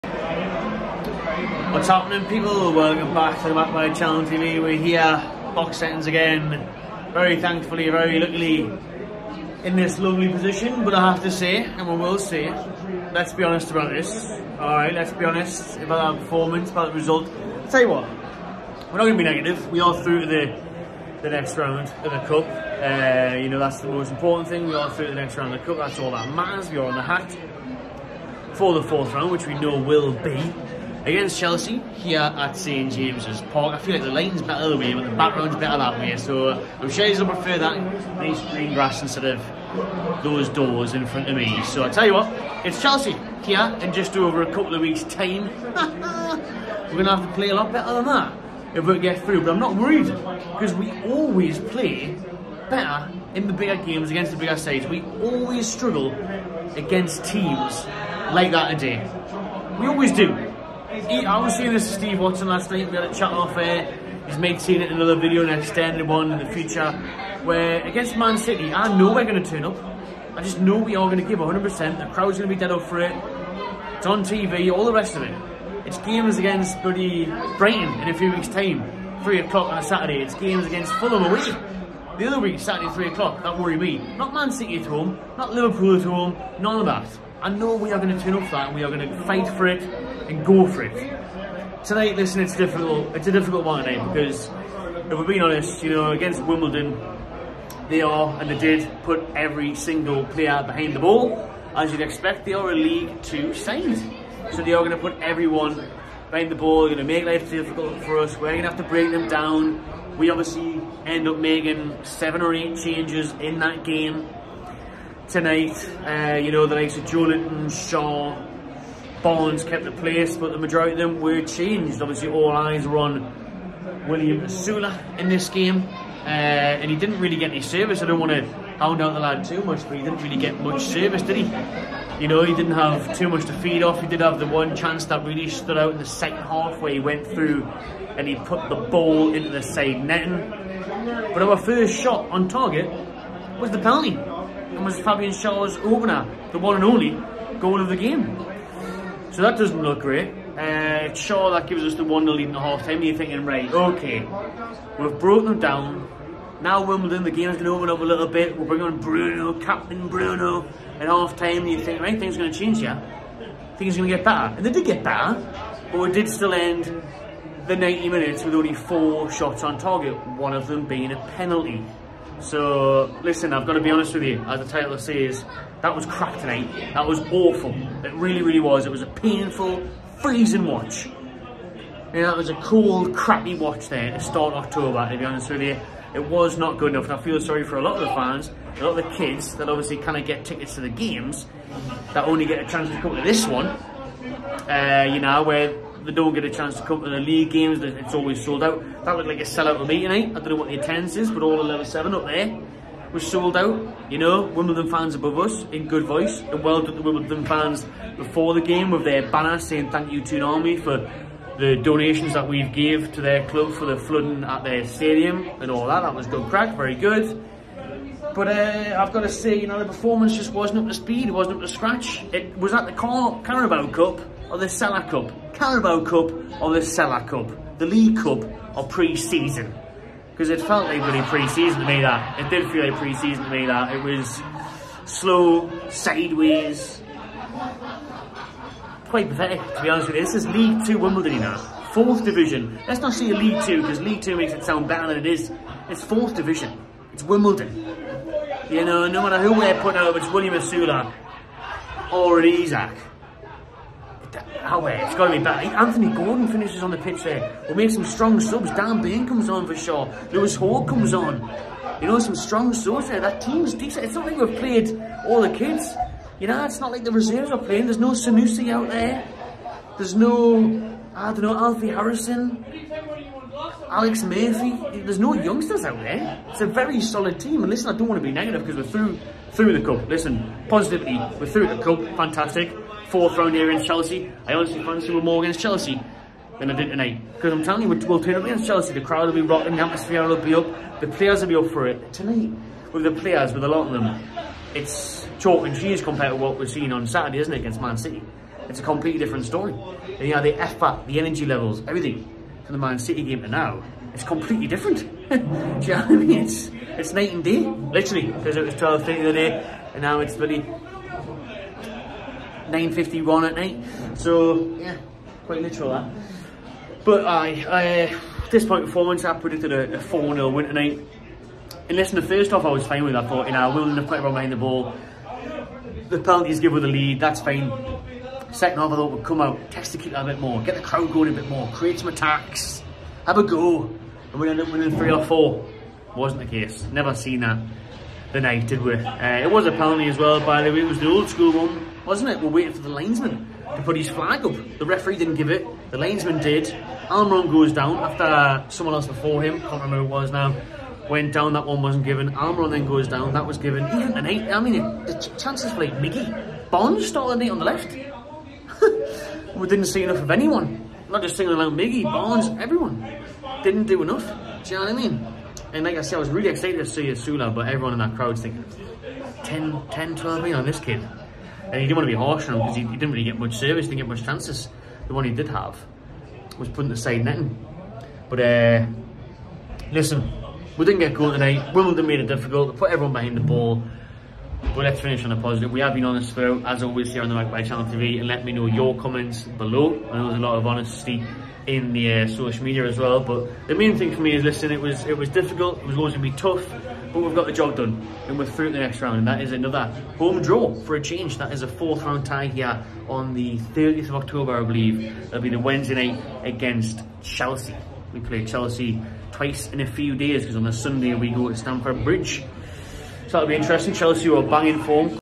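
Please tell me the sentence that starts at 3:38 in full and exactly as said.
But uh, I've got to say, you know, the performance just wasn't up to speed.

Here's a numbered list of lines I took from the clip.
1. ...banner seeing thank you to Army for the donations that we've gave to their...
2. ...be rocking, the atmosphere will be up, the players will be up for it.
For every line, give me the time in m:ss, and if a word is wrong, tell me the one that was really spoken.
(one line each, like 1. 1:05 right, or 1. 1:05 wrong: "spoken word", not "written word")
1. 3:29 wrong: "saying", not "seeing"
2. 4:49 right.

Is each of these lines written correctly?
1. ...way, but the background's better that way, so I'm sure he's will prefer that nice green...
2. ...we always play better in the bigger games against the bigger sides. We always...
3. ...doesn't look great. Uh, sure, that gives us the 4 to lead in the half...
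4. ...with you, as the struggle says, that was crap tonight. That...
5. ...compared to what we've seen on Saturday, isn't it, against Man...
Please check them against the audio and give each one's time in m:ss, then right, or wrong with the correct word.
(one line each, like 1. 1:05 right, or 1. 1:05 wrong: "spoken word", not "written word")
1. 0:34 right
2. 0:50 right
3. 2:29 wrong: "1", not "4"
4. 2:54 wrong: "title", not "struggle"
5. 4:56 right.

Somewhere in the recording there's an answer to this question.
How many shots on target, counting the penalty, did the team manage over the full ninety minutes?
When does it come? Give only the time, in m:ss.
2:48.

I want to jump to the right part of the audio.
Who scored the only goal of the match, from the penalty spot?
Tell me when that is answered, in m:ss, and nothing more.
2:24.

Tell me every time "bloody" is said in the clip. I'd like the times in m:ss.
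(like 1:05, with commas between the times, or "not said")
1:16, 5:10.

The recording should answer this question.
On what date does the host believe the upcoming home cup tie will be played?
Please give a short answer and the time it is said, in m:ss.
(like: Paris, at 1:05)
30th of October, at 6:43.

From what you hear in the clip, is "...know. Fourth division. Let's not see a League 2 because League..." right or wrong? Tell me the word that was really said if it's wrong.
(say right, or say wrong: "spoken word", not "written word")
right.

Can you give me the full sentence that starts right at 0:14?
Alright, let's be honest about our performance, about the result.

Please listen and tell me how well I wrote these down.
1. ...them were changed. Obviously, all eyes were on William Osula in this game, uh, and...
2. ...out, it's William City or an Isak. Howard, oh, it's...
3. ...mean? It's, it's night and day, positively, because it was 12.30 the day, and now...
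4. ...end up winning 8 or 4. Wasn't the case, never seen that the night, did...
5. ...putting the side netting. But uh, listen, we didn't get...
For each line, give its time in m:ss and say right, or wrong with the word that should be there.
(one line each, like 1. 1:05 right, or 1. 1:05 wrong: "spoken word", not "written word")
1. 2:00 right
2. 4:09 wrong: "Osula", not "City"
3. 5:06 wrong: "literally", not "positively"
4. 5:34 wrong: "3", not "8"
5. 6:16 right.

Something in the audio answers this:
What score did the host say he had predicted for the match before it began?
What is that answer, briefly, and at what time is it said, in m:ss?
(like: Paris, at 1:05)
4-0, at 5:19.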